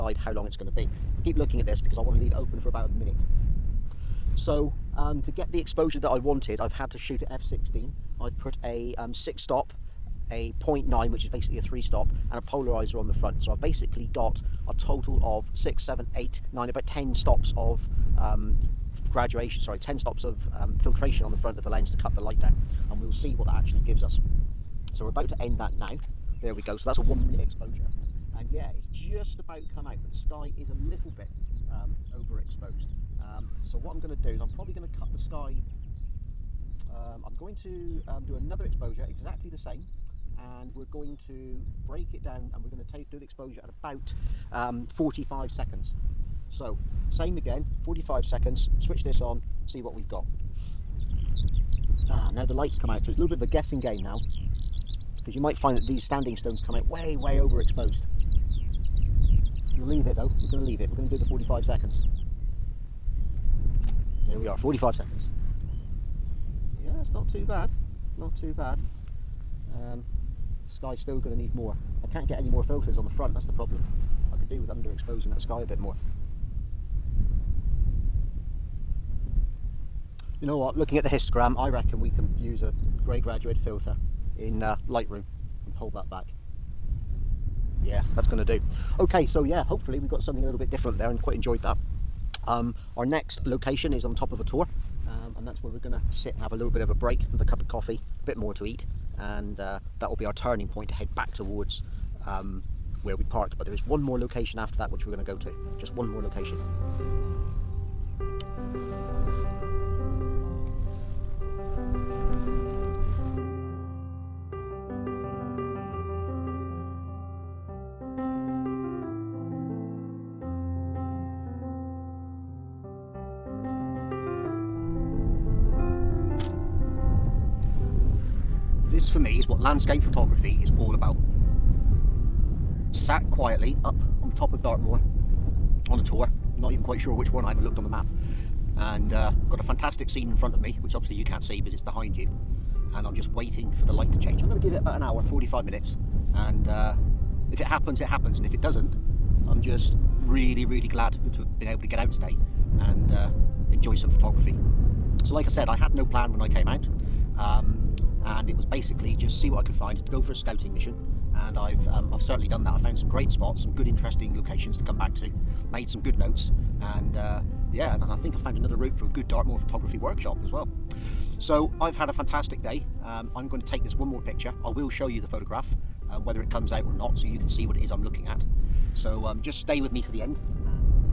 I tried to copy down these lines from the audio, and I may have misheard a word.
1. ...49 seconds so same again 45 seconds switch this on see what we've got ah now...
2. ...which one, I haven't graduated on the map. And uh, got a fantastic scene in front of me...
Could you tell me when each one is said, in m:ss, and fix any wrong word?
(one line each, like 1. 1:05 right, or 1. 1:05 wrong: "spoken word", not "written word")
1. 0:44 wrong: "45", not "49"
2. 2:17 wrong: "looked", not "graduated".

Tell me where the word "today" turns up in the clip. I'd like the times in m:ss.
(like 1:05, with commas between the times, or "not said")
2:32.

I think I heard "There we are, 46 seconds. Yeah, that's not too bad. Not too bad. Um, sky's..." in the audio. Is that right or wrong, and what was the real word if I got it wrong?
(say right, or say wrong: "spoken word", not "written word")
wrong: "45", not "46".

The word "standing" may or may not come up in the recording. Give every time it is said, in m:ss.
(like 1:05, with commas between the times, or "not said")
0:56.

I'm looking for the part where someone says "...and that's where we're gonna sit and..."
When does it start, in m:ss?
1:35.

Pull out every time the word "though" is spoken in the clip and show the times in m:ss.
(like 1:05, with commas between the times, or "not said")
1:00.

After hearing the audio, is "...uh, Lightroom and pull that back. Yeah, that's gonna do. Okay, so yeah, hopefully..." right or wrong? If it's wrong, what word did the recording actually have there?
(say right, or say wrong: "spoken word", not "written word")
right.